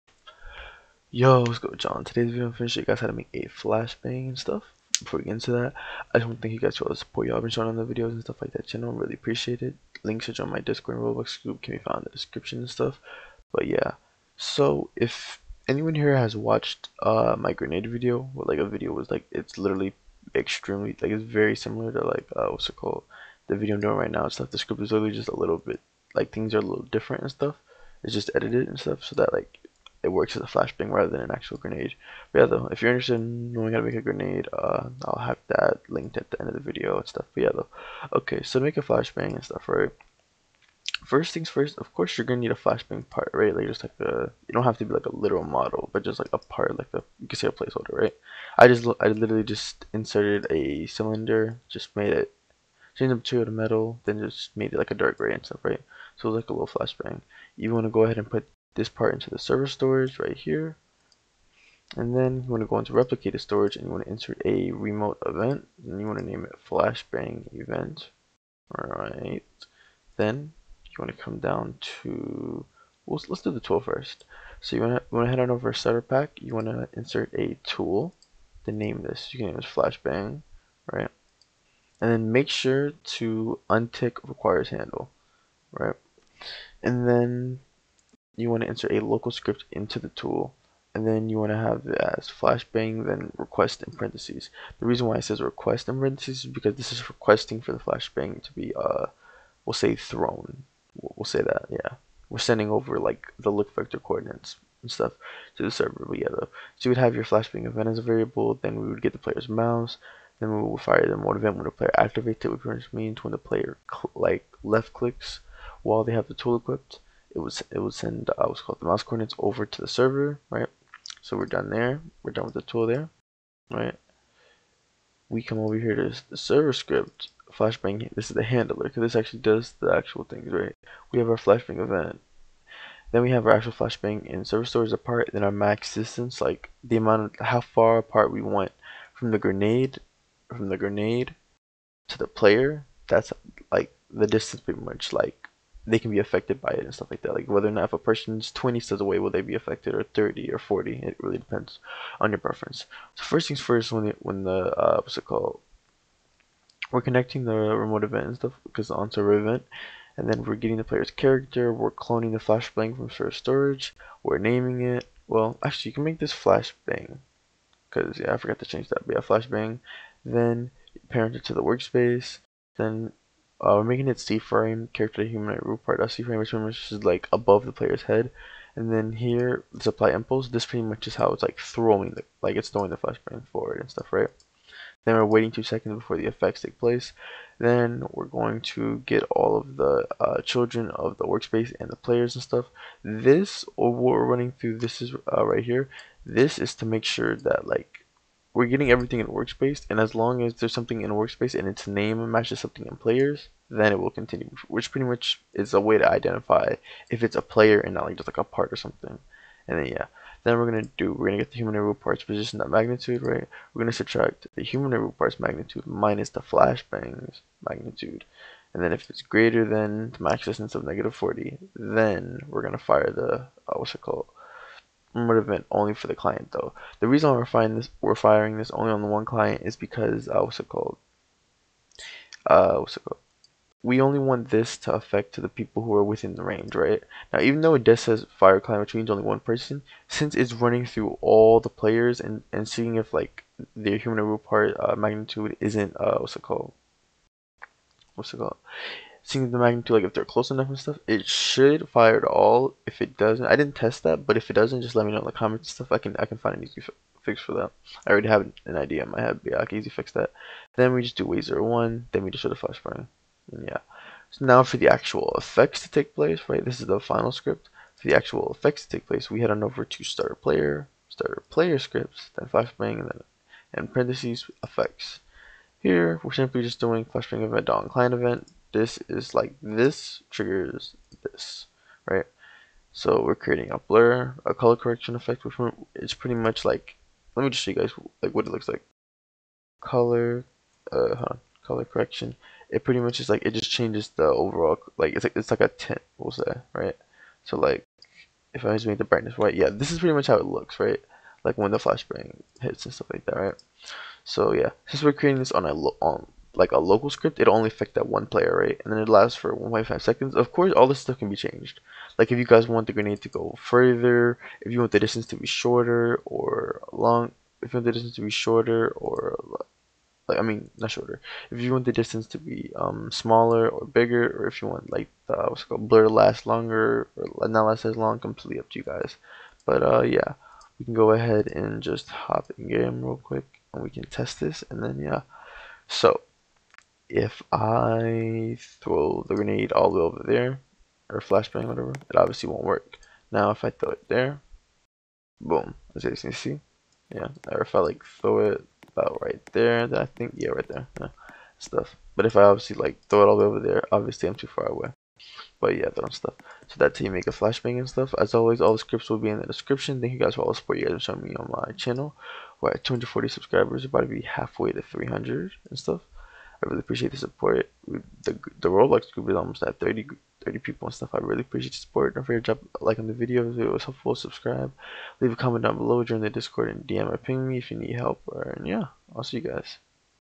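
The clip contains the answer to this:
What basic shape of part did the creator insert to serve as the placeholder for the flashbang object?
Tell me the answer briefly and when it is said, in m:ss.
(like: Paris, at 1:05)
cylinder, at 0:50.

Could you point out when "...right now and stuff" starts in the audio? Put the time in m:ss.
0:23.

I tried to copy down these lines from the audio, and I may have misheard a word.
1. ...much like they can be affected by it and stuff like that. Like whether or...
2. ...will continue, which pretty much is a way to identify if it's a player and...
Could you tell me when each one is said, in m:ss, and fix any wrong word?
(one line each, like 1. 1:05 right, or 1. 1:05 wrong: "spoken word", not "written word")
1. 2:24 right
2. 3:23 right.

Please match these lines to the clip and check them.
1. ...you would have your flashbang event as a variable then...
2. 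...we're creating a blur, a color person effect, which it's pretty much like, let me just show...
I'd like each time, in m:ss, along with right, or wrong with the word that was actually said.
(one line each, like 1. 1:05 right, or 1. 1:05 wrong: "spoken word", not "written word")
1. 1:46 right
2. 4:43 wrong: "correction", not "person".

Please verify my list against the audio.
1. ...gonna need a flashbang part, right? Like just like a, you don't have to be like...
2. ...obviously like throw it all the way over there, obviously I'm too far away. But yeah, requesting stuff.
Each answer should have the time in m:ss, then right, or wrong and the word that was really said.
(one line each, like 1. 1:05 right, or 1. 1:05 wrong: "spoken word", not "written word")
1. 0:42 right
2. 5:52 wrong: "throwing", not "requesting".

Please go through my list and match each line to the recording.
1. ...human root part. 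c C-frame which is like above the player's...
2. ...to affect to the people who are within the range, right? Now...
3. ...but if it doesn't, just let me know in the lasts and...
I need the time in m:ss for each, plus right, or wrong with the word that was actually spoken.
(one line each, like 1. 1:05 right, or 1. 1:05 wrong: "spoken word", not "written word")
1. 2:55 right
2. 3:54 right
3. 4:14 wrong: "comments", not "lasts".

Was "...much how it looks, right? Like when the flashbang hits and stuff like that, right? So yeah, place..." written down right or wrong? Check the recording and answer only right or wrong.
wrong.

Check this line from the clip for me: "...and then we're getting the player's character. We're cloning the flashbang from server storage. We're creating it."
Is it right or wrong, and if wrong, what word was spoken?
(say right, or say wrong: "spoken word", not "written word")
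wrong: "naming", not "creating".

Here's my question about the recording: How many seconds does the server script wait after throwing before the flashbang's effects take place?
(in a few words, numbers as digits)
2.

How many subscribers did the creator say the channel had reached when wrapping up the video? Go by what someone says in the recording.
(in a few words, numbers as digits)
240.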